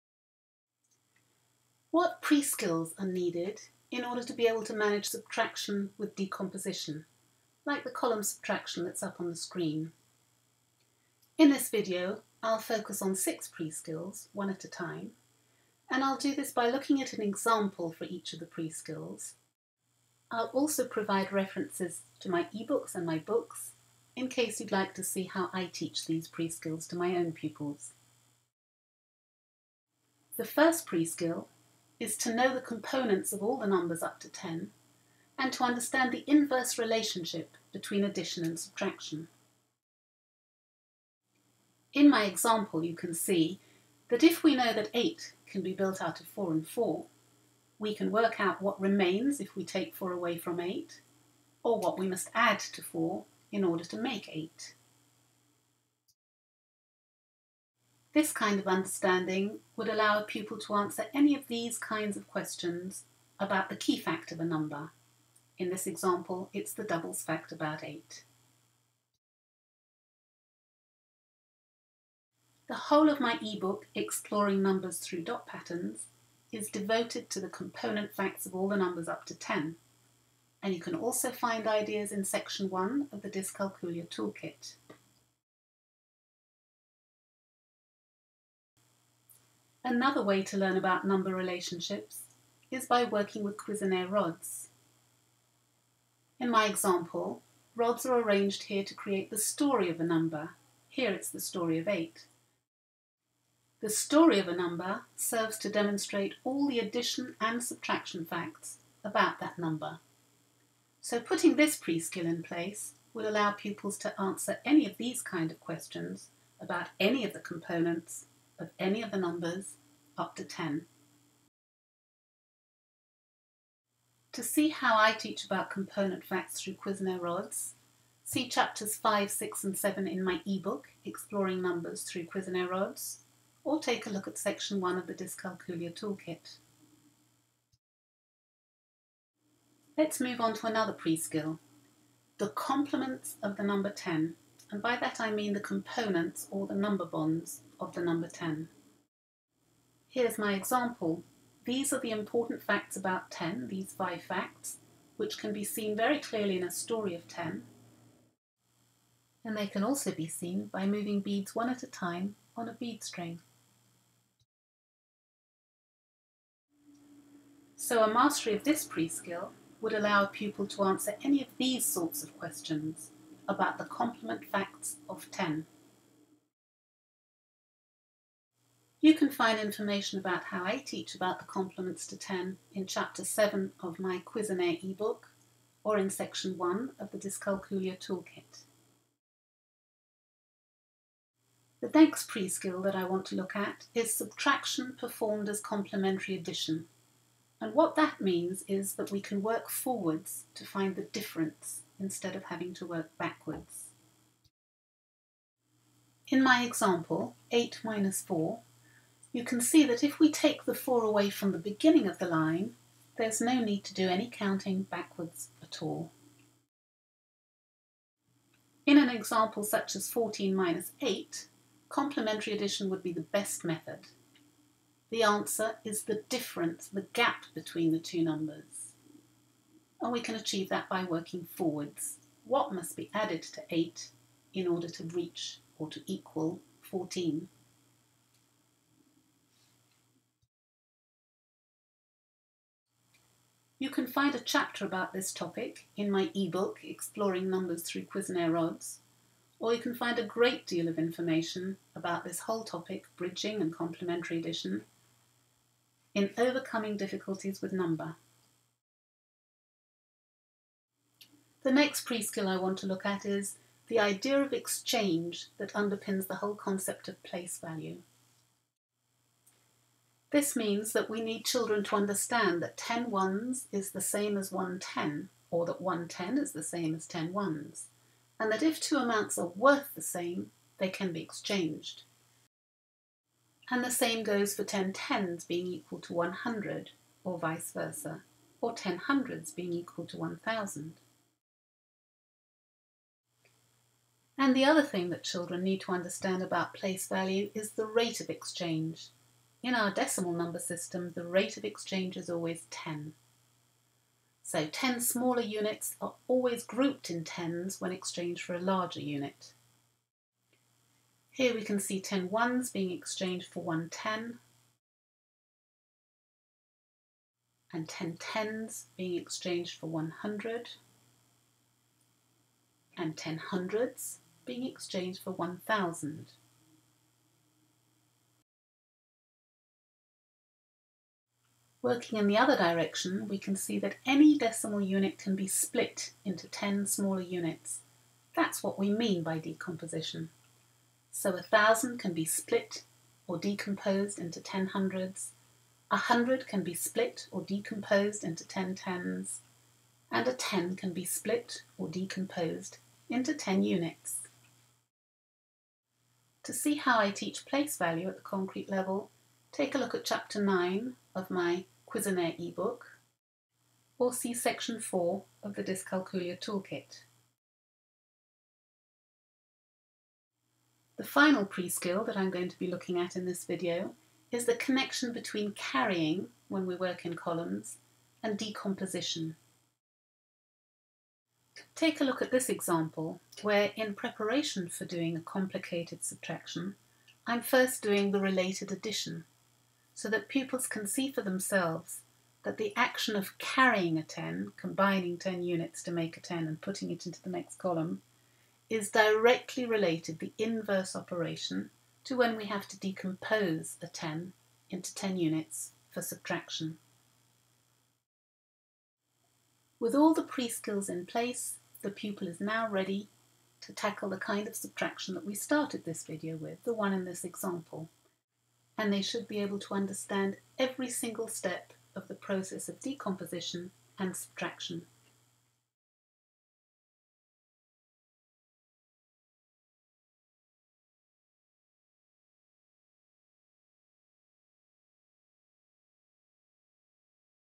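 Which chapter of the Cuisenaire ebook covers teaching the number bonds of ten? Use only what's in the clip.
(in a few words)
Chapter 7.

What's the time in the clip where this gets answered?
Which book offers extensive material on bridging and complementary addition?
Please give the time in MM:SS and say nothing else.
04:16.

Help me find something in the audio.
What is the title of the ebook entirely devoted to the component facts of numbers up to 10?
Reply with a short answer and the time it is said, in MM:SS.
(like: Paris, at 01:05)
Exploring Numbers Through Dot Patterns, at 01:13.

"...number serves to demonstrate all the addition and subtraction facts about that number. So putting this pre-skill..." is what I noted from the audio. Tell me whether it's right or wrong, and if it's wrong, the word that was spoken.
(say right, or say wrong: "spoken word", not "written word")
right.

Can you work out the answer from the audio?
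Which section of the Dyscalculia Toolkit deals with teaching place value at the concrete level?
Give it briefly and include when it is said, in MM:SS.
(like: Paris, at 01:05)
Section 4, at 06:04.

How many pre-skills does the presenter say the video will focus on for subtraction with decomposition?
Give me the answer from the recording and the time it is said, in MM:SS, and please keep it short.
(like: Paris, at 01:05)
6, at 00:13.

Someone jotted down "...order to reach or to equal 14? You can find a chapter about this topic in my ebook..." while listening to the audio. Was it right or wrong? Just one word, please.
right.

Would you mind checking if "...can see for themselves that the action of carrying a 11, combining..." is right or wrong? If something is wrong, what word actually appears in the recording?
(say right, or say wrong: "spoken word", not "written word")
wrong: "10", not "11".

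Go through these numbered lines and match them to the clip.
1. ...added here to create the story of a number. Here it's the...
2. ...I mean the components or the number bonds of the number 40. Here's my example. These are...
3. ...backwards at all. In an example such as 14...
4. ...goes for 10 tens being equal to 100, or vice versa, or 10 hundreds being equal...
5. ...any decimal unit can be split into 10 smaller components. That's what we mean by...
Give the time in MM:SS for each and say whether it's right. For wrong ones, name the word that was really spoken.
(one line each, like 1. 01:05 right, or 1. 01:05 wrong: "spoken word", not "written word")
1. 01:38 wrong: "arranged", not "added"
2. 02:25 wrong: "10", not "40"
3. 03:34 right
4. 04:44 right
5. 05:34 wrong: "units", not "components".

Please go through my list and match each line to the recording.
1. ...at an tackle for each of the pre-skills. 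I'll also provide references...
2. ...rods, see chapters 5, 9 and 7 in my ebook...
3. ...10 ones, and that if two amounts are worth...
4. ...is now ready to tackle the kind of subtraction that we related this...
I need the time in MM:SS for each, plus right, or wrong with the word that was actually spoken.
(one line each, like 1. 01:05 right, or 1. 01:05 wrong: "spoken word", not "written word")
1. 00:17 wrong: "example", not "tackle"
2. 02:07 wrong: "6", not "9"
3. 04:37 right
4. 06:52 wrong: "started", not "related".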